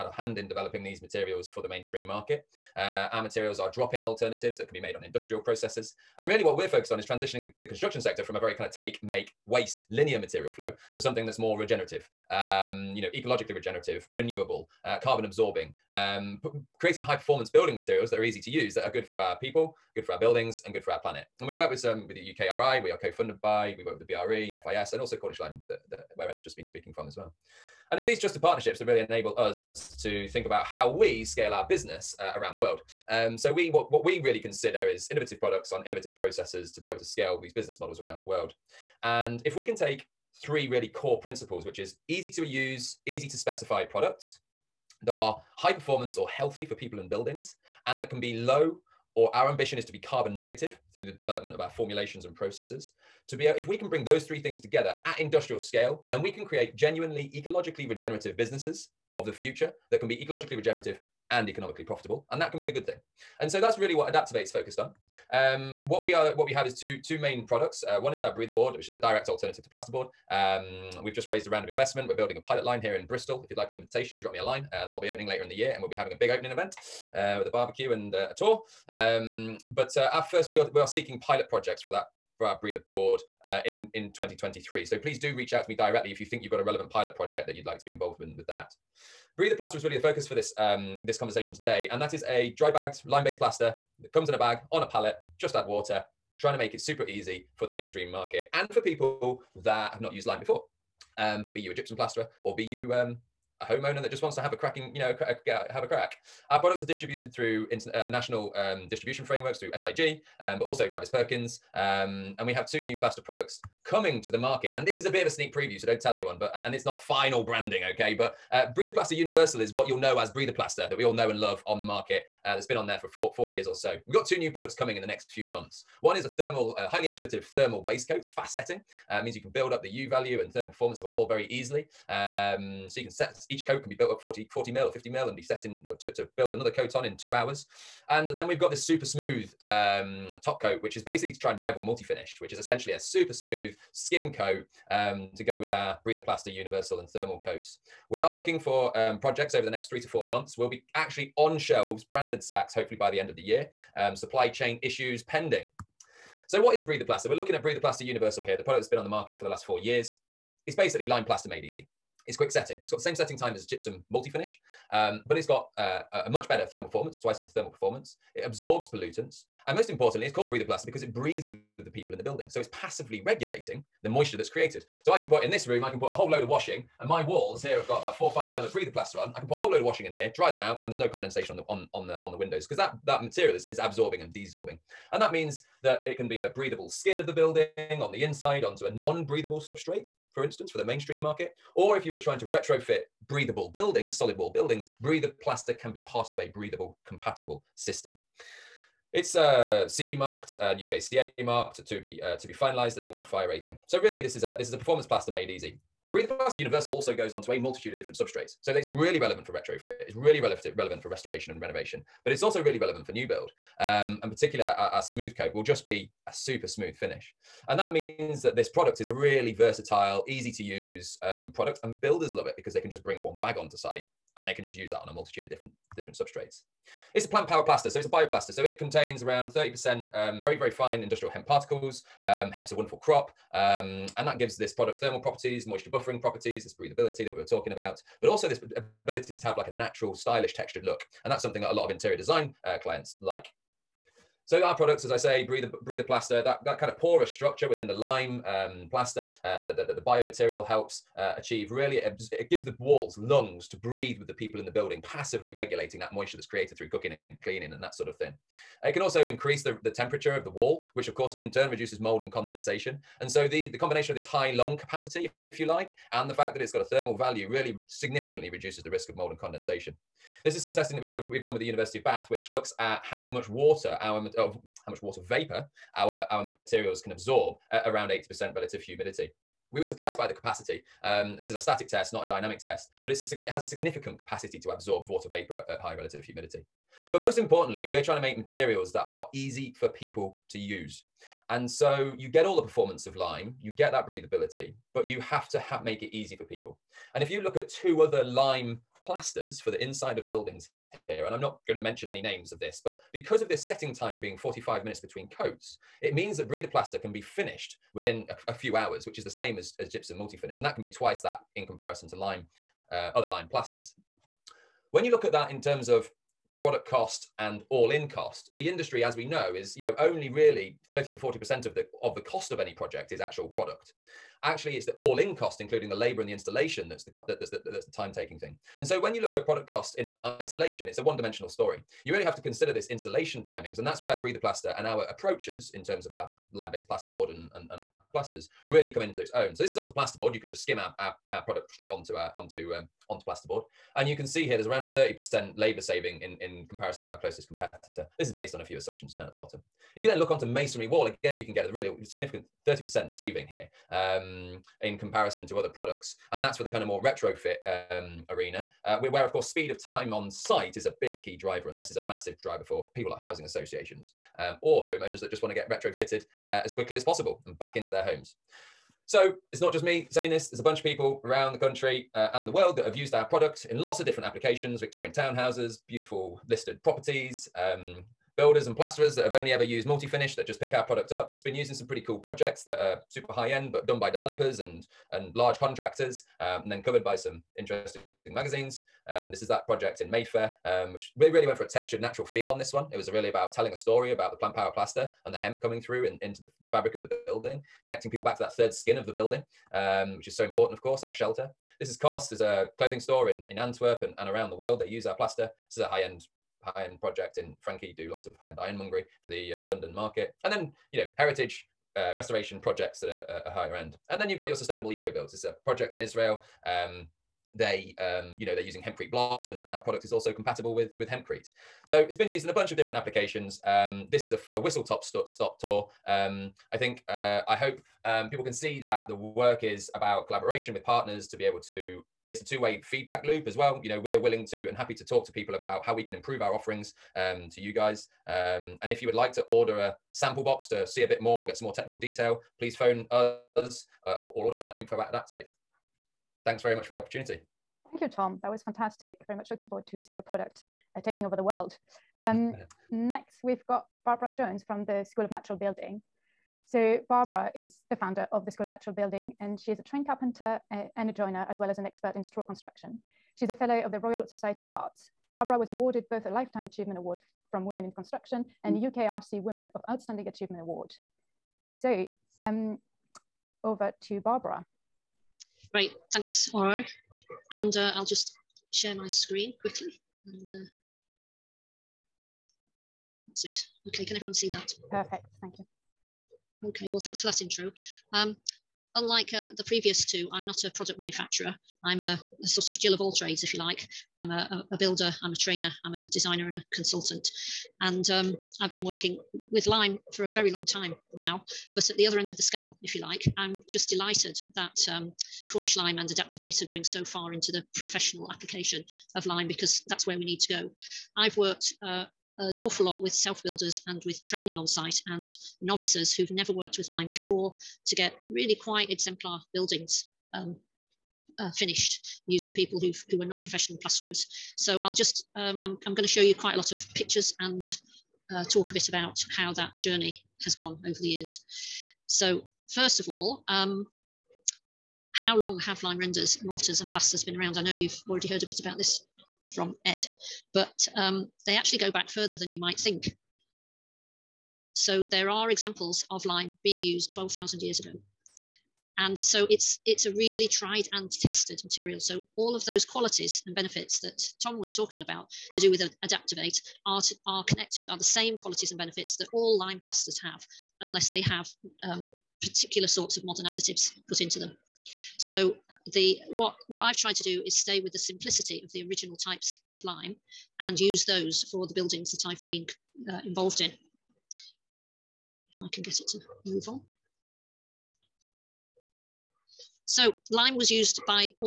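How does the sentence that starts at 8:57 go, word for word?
I know you've already heard a bit about this from Ed, but um, they actually go back further than you might think.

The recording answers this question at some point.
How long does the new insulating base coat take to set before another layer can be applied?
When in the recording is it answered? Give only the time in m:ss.
2:17.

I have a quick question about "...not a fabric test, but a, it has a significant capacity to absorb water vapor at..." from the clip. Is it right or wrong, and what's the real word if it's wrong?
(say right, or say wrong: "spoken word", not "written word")
wrong: "dynamic", not "fabric".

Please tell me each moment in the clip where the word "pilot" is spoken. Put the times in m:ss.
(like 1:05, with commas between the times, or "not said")
1:12, 1:21, 1:26.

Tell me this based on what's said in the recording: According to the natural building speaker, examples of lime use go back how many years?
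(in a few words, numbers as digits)
12,000 years.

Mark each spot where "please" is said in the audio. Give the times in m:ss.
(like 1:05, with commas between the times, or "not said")
1:24, 7:22.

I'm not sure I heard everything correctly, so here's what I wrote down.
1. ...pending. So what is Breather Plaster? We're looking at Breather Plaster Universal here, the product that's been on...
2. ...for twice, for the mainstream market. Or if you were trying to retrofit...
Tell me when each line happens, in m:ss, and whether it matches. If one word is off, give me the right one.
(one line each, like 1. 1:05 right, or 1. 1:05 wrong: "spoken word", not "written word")
1. 2:35 right
2. 3:10 wrong: "instance", not "twice".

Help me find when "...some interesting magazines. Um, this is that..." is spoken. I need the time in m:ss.
6:27.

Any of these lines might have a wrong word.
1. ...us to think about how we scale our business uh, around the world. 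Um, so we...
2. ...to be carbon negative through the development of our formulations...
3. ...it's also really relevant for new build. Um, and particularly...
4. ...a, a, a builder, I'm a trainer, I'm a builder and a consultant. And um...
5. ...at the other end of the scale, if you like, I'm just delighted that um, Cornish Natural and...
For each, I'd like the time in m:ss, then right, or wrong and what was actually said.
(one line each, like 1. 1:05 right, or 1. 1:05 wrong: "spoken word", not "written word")
1. 0:29 right
2. 0:49 right
3. 3:32 right
4. 8:14 wrong: "designer", not "builder"
5. 8:21 wrong: "Lime", not "Natural".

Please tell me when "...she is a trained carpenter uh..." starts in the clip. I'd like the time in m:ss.
7:39.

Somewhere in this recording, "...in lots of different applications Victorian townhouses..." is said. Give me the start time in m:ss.
6:13.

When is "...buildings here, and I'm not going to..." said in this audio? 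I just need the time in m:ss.
5:00.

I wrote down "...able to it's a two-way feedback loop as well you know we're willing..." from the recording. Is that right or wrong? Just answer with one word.
right.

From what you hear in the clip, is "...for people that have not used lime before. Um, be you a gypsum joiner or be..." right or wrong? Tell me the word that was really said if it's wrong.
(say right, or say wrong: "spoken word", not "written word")
wrong: "plasterer", not "joiner".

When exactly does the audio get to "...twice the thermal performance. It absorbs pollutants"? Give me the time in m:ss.
2:47.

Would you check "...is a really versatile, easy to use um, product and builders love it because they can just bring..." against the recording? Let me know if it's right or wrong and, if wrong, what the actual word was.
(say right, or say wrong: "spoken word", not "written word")
right.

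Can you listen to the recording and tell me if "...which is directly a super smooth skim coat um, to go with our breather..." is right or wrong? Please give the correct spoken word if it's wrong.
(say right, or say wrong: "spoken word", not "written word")
wrong: "essentially", not "directly".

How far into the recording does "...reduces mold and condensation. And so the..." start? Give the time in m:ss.
4:21.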